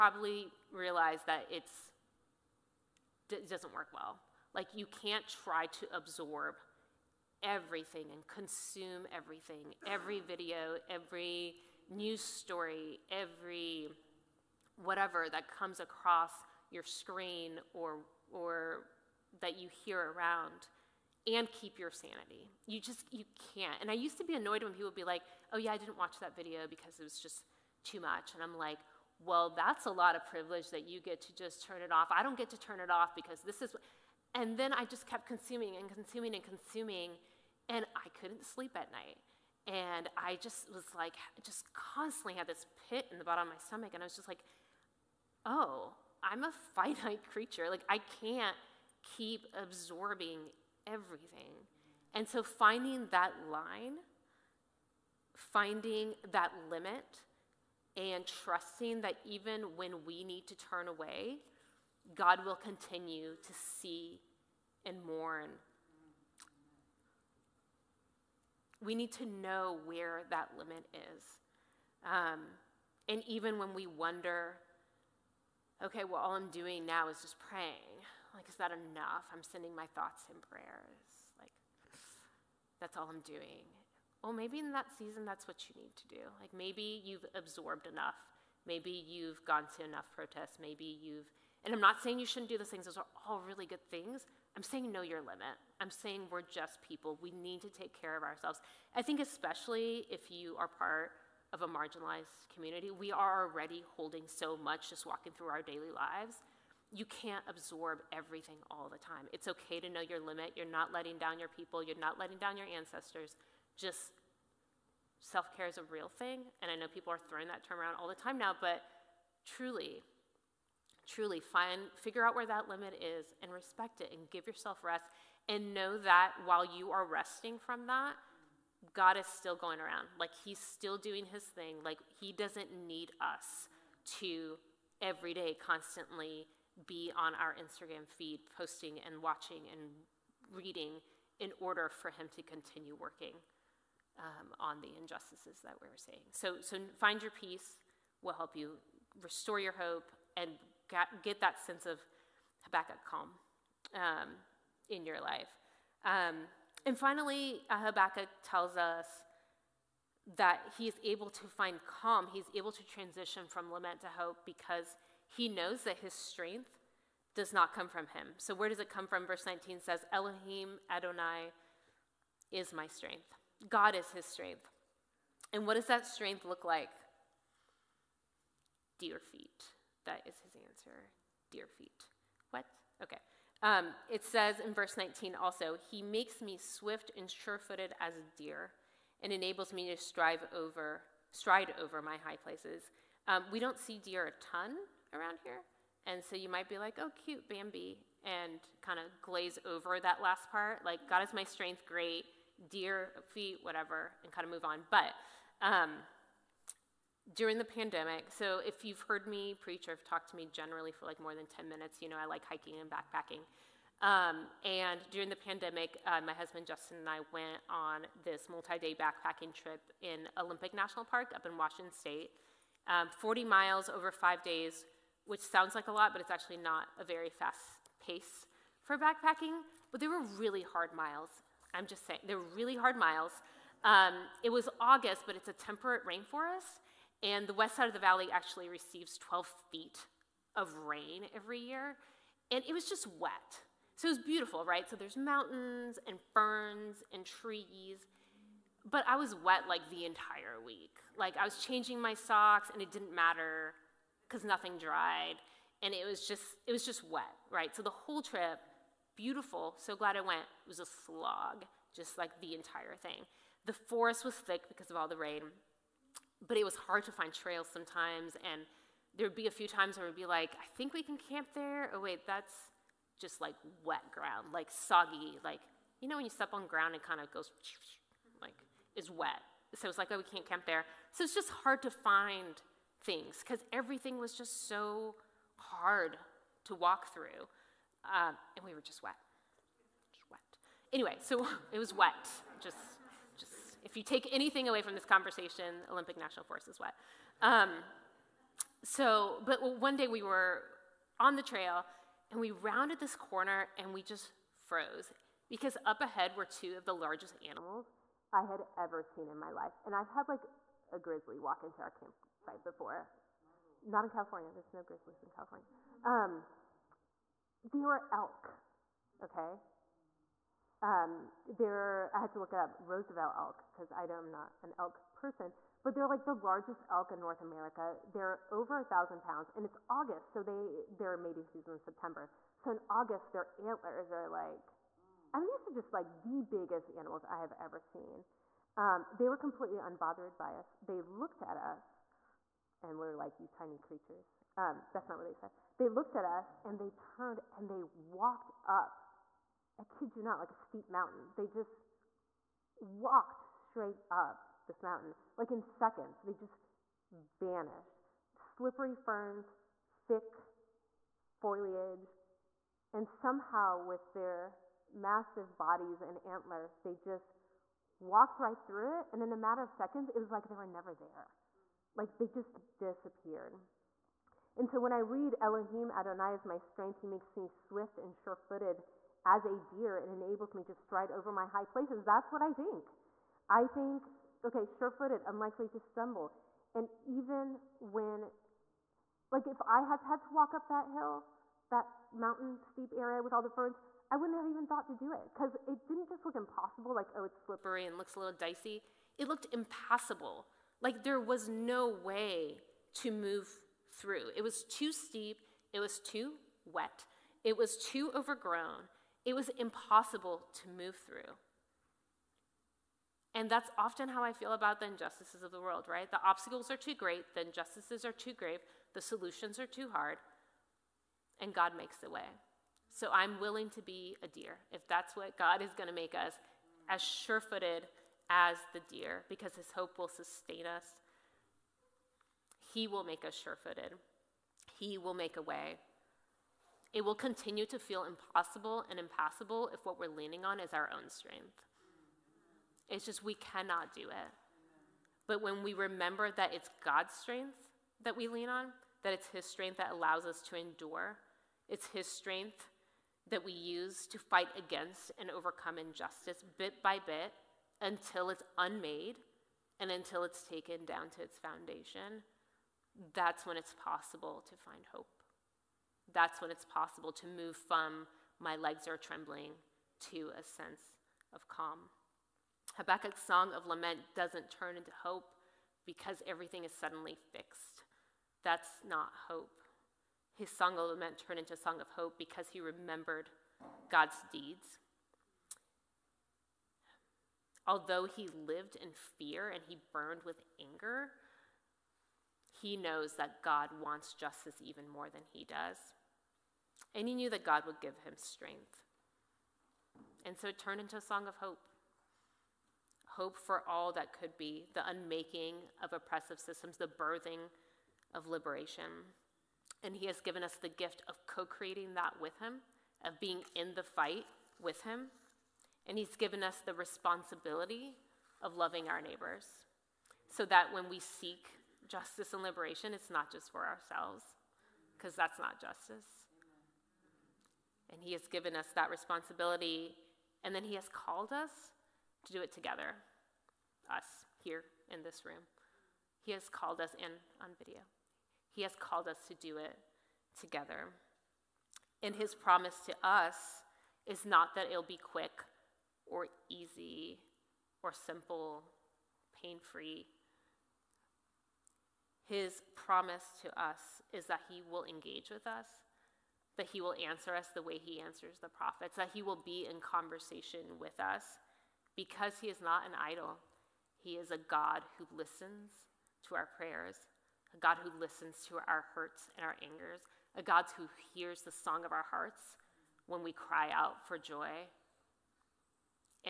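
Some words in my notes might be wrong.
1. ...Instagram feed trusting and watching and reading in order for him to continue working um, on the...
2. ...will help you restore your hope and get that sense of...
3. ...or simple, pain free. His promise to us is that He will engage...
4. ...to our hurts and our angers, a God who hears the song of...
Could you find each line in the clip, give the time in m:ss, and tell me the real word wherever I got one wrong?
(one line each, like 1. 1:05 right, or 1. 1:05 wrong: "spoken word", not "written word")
1. 2:17 wrong: "posting", not "trusting"
2. 2:28 right
3. 9:07 right
4. 9:28 right.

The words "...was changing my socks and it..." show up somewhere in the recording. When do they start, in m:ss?
4:11.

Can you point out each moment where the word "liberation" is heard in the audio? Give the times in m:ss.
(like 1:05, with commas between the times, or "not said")
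8:28, 8:42.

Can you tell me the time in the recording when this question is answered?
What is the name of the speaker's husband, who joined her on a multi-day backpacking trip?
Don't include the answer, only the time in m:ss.
3:36.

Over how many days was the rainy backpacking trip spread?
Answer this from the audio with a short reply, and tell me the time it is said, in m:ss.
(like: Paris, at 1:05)
5, at 3:44.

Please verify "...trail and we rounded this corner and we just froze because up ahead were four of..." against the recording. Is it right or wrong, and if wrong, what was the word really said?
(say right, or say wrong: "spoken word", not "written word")
wrong: "two", not "four".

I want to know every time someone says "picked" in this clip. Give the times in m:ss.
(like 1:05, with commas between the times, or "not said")
not said.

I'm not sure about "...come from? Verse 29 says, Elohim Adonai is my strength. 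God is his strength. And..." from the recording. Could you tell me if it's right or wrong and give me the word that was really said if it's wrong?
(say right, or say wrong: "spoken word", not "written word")
wrong: "19", not "29".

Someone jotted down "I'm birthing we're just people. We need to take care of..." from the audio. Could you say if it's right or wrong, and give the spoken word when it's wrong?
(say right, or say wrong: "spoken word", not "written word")
wrong: "saying", not "birthing".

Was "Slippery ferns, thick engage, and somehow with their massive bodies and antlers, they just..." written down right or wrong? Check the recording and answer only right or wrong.
wrong.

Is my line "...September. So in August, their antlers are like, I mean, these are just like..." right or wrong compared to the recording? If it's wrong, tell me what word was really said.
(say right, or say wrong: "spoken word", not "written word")
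right.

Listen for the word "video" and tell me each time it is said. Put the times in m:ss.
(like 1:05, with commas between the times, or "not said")
0:10, 0:26, 8:57.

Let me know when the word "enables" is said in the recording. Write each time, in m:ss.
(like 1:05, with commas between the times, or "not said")
3:09, 6:20.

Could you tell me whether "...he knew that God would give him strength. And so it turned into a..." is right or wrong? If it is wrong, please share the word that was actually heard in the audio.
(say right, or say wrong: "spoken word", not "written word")
right.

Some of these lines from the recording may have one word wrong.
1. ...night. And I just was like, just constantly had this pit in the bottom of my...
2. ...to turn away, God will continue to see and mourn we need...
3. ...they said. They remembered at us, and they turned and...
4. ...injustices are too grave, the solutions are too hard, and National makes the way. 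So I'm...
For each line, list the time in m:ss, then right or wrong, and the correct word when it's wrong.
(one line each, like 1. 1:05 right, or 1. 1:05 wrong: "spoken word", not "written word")
1. 0:38 right
2. 1:00 right
3. 5:45 wrong: "looked", not "remembered"
4. 6:57 wrong: "God", not "National".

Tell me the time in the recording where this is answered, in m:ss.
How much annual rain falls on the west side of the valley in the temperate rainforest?
3:59.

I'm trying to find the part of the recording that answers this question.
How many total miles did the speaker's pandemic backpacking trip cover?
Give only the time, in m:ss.
3:43.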